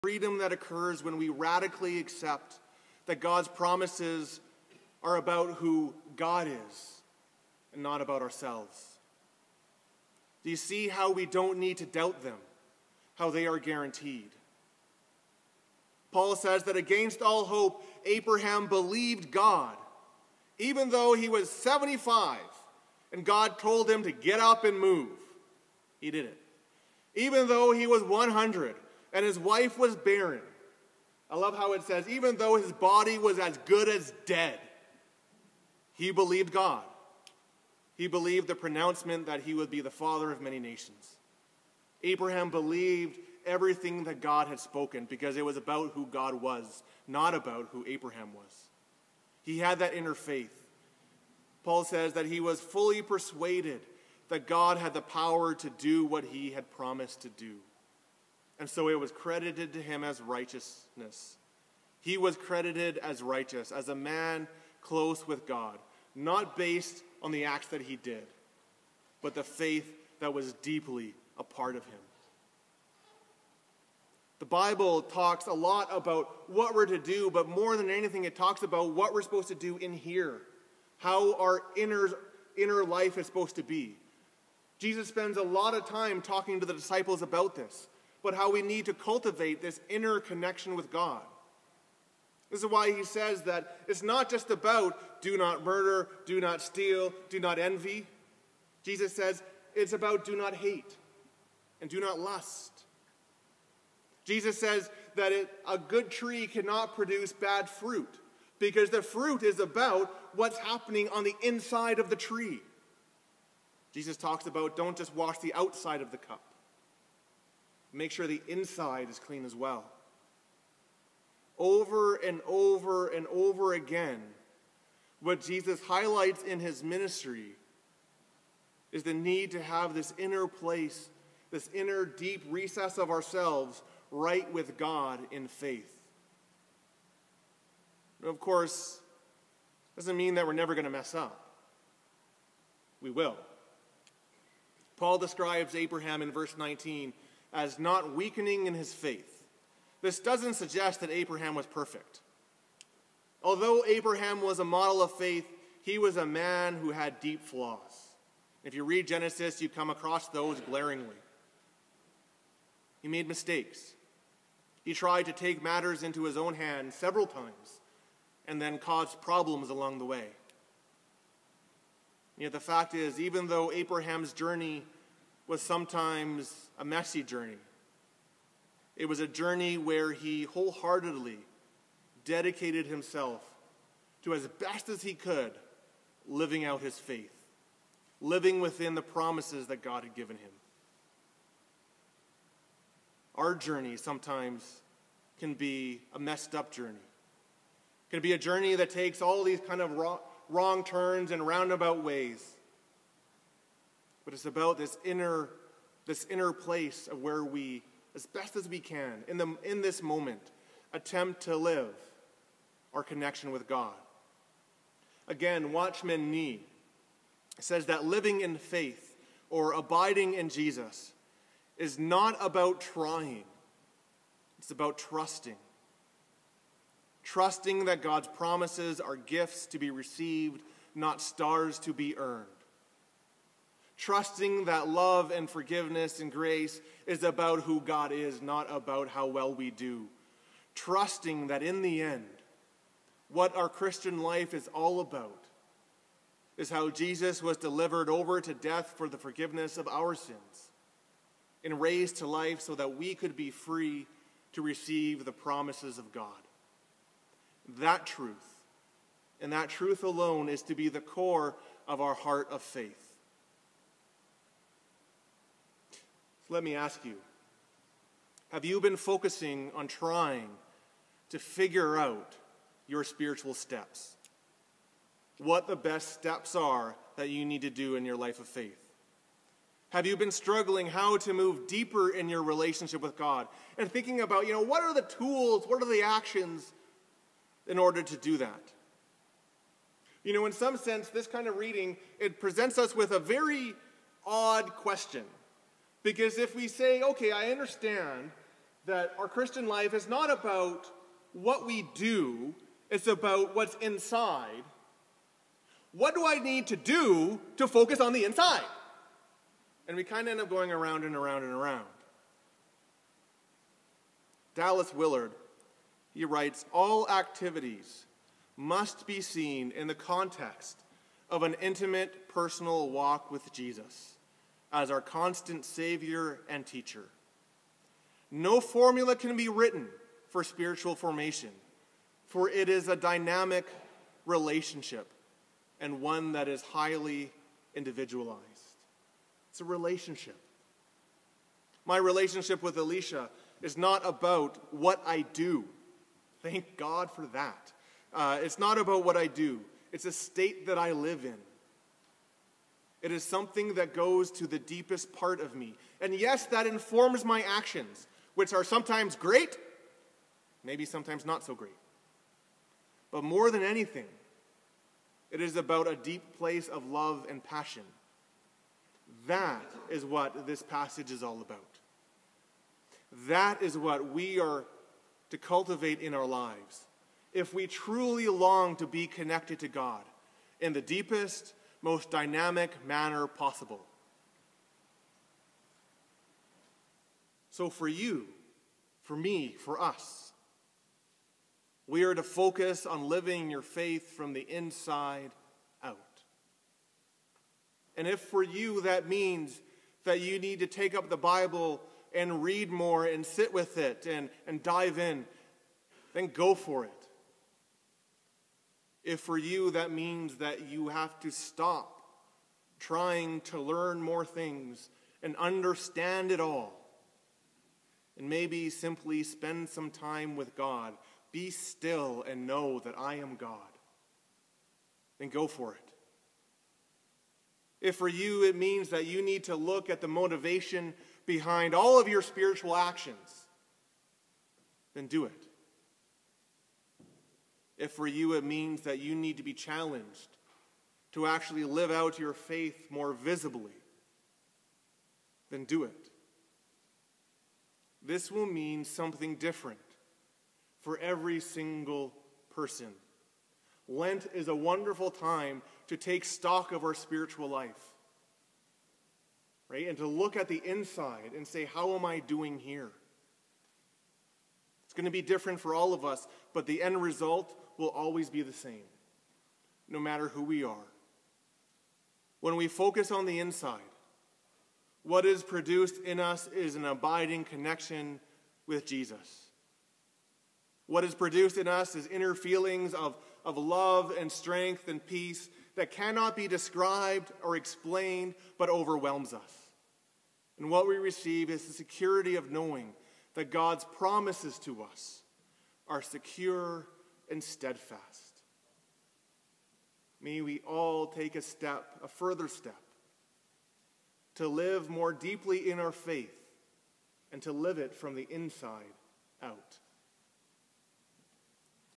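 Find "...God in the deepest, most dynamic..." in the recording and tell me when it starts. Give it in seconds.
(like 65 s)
379 s.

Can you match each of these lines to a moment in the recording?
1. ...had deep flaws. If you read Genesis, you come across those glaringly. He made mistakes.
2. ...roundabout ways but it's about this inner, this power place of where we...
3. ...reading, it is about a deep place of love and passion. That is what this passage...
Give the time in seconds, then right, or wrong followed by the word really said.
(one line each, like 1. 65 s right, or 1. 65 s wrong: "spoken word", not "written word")
1. 156 s right
2. 201 s wrong: "inner", not "power"
3. 363 s wrong: "anything", not "reading".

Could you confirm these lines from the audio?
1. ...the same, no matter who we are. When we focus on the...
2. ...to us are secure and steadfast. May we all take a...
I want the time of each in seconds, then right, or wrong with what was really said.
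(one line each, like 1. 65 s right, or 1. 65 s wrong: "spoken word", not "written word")
1. 468 s right
2. 494 s right.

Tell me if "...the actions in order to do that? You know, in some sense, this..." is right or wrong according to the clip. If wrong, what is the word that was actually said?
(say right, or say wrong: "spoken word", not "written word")
right.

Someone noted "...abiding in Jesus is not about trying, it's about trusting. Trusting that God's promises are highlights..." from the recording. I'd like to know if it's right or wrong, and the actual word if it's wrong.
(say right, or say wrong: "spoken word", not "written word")
wrong: "gifts", not "highlights".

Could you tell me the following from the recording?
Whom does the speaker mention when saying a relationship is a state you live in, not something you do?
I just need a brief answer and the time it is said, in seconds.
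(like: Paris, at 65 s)
Alicia, at 342 s.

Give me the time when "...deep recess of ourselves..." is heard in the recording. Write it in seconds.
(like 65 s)
132 s.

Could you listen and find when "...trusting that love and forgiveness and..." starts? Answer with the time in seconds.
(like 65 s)
234 s.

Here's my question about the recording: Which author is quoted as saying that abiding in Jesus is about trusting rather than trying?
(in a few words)
Watchman Nee.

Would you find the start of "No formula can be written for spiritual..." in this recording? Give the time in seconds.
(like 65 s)
328 s.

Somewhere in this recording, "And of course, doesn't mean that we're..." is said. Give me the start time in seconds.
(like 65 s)
138 s.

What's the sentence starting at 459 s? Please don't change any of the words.
And to look at the inside and say, How am I doing here?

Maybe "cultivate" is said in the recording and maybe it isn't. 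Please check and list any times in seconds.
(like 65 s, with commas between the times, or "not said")
88 s, 375 s.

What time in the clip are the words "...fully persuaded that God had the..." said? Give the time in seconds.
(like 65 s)
52 s.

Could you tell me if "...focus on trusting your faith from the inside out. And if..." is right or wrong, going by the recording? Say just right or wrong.
wrong.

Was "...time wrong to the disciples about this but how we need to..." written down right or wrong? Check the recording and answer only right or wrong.
wrong.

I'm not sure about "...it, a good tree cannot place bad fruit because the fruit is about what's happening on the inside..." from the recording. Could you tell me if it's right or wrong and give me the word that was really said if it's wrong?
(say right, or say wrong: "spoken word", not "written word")
wrong: "produce", not "place".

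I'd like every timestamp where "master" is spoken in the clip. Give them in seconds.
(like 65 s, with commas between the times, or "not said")
not said.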